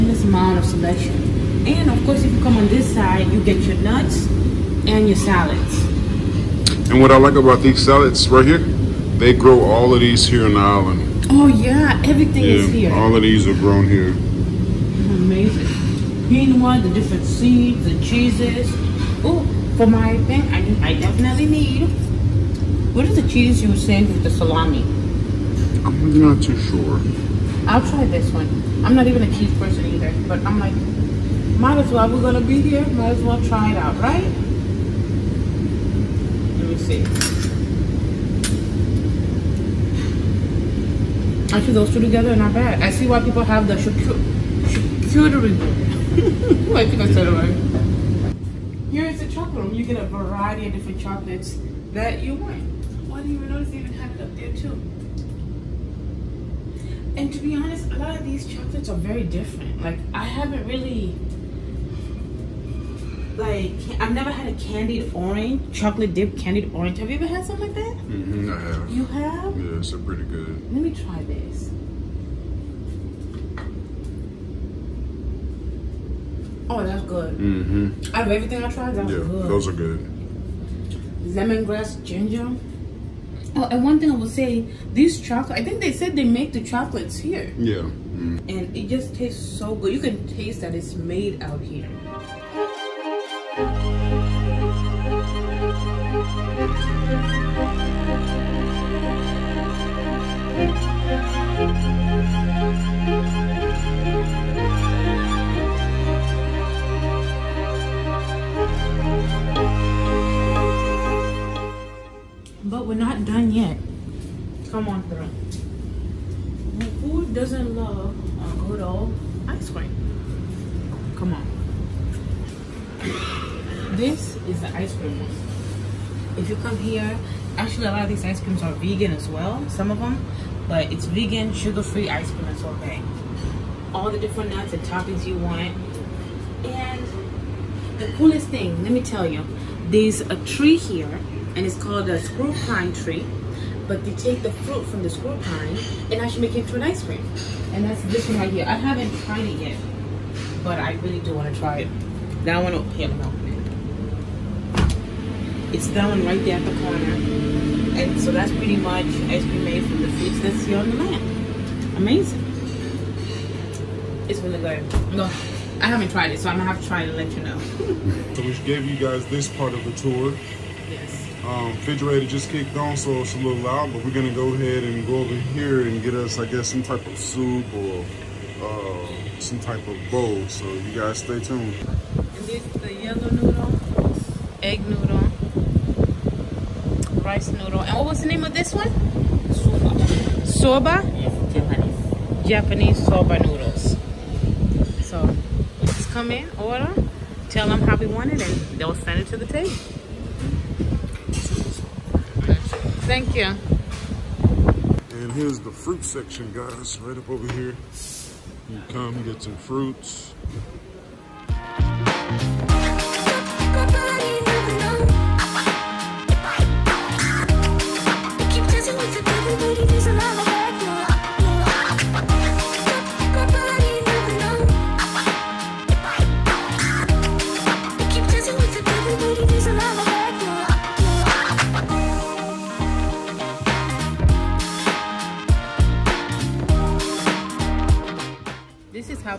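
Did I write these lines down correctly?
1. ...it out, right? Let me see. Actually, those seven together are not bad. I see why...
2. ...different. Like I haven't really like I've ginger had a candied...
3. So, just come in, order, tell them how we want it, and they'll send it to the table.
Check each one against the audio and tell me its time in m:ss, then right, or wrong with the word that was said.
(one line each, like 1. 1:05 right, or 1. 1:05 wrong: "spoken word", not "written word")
1. 0:33 wrong: "two", not "seven"
2. 0:59 wrong: "never", not "ginger"
3. 3:15 right.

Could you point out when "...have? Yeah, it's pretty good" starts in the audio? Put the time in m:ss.
1:09.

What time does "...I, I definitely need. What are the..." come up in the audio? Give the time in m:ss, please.
0:20.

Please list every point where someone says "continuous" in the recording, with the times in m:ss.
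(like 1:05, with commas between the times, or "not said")
not said.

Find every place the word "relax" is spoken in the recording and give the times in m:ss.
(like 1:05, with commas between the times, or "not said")
not said.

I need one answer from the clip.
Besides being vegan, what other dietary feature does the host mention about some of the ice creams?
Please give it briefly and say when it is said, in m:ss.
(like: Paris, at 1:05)
sugar-free, at 2:11.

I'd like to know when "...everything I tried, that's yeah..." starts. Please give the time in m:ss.
1:18.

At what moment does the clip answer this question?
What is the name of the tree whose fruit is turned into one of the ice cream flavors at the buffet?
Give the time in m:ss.
2:22.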